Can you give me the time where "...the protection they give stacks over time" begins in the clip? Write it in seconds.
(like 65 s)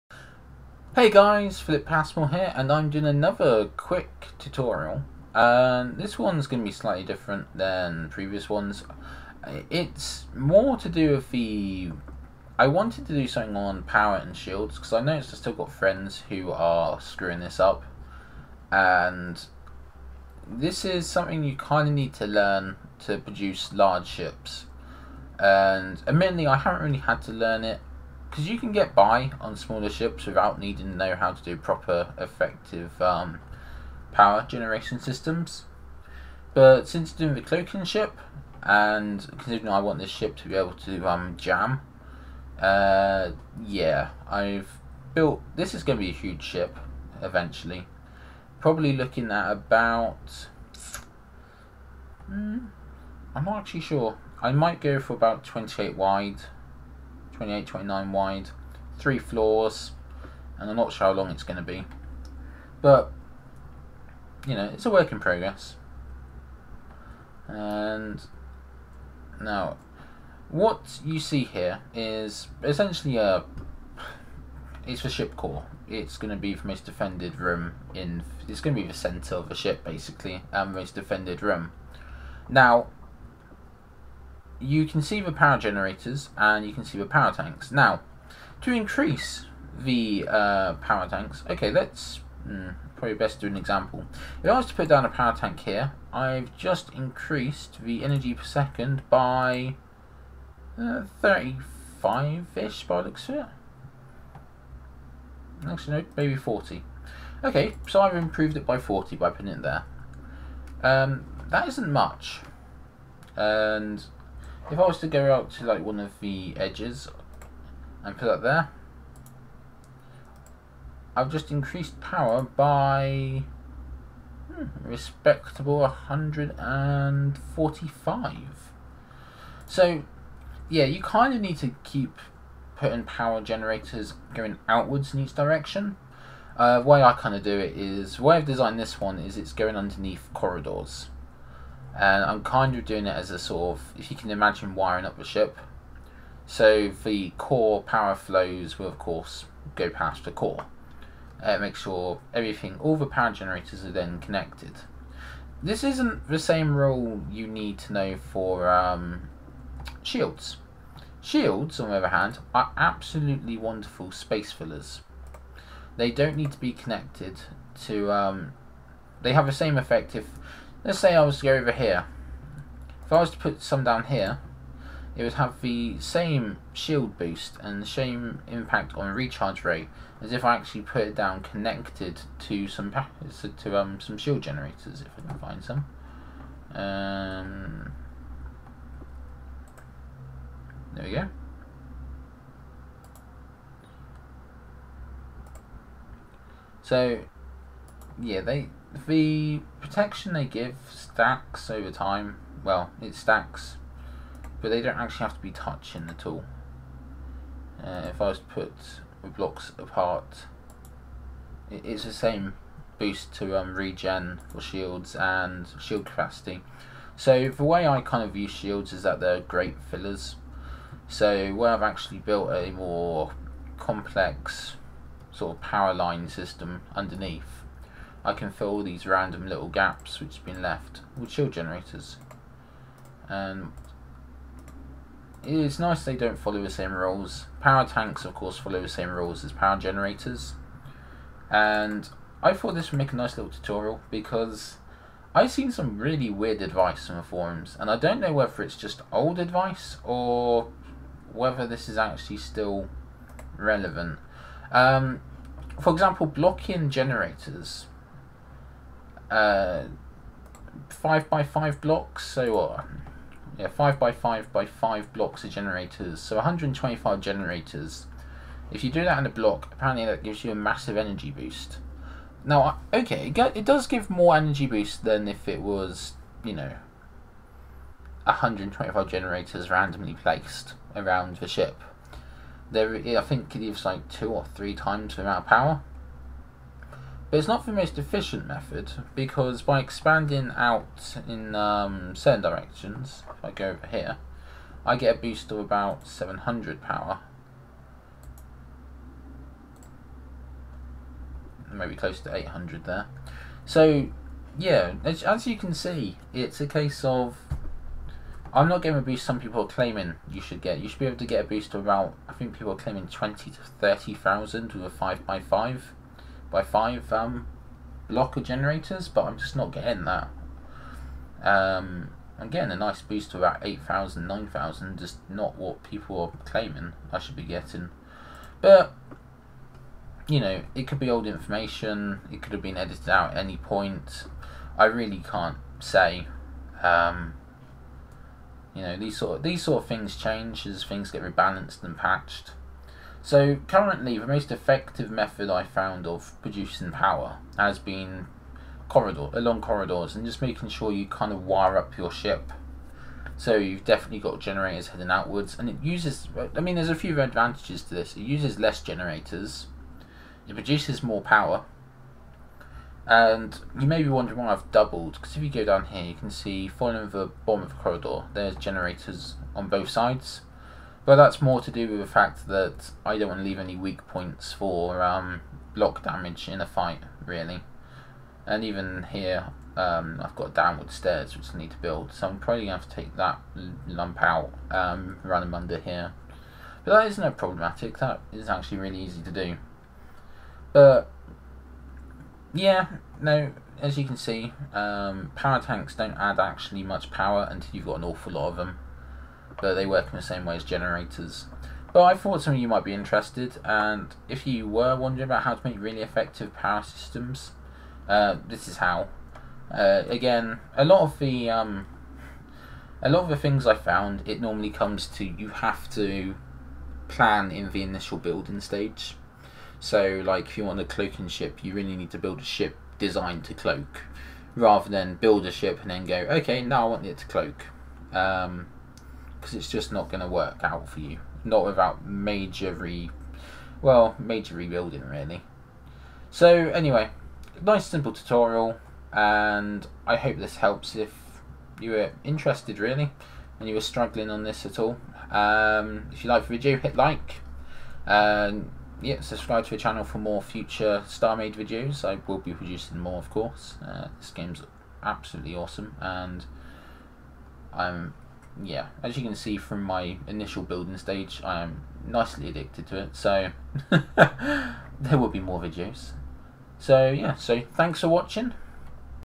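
199 s.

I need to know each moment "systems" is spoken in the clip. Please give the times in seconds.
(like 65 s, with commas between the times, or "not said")
35 s, 226 s, 406 s.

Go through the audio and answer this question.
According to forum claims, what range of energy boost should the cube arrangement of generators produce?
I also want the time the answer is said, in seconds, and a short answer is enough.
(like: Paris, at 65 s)
20 to 30,000, at 313 s.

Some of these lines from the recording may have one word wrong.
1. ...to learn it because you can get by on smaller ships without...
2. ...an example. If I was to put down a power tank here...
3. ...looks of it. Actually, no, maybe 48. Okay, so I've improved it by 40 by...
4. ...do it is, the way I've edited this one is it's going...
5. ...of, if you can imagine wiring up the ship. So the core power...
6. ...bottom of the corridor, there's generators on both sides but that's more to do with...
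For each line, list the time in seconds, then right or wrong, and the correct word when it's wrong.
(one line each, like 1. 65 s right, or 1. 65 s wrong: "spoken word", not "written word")
1. 27 s right
2. 93 s right
3. 103 s wrong: "40", not "48"
4. 137 s wrong: "designed", not "edited"
5. 143 s right
6. 367 s right.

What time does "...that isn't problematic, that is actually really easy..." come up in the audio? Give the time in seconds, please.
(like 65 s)
386 s.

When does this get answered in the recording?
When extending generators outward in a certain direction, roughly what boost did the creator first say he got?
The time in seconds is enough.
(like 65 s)
296 s.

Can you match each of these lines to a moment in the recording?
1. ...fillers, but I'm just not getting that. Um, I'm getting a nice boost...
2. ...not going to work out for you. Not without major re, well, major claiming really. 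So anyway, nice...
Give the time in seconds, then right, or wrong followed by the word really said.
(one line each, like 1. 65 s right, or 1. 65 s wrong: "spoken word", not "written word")
1. 318 s wrong: "generators", not "fillers"
2. 429 s wrong: "rebuilding", not "claiming".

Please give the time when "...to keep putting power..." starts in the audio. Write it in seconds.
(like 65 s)
131 s.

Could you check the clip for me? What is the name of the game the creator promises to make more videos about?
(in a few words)
StarMade.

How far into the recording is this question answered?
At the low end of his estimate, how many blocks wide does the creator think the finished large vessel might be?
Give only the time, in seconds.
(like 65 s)
55 s.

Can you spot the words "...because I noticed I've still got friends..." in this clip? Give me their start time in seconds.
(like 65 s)
14 s.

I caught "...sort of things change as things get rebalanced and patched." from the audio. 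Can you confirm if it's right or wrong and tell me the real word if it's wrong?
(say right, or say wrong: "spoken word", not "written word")
right.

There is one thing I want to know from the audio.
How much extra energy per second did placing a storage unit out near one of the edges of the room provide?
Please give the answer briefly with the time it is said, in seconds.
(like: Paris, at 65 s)
145, at 125 s.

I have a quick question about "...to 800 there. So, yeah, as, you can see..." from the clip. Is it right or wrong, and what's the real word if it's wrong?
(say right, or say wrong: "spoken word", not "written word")
right.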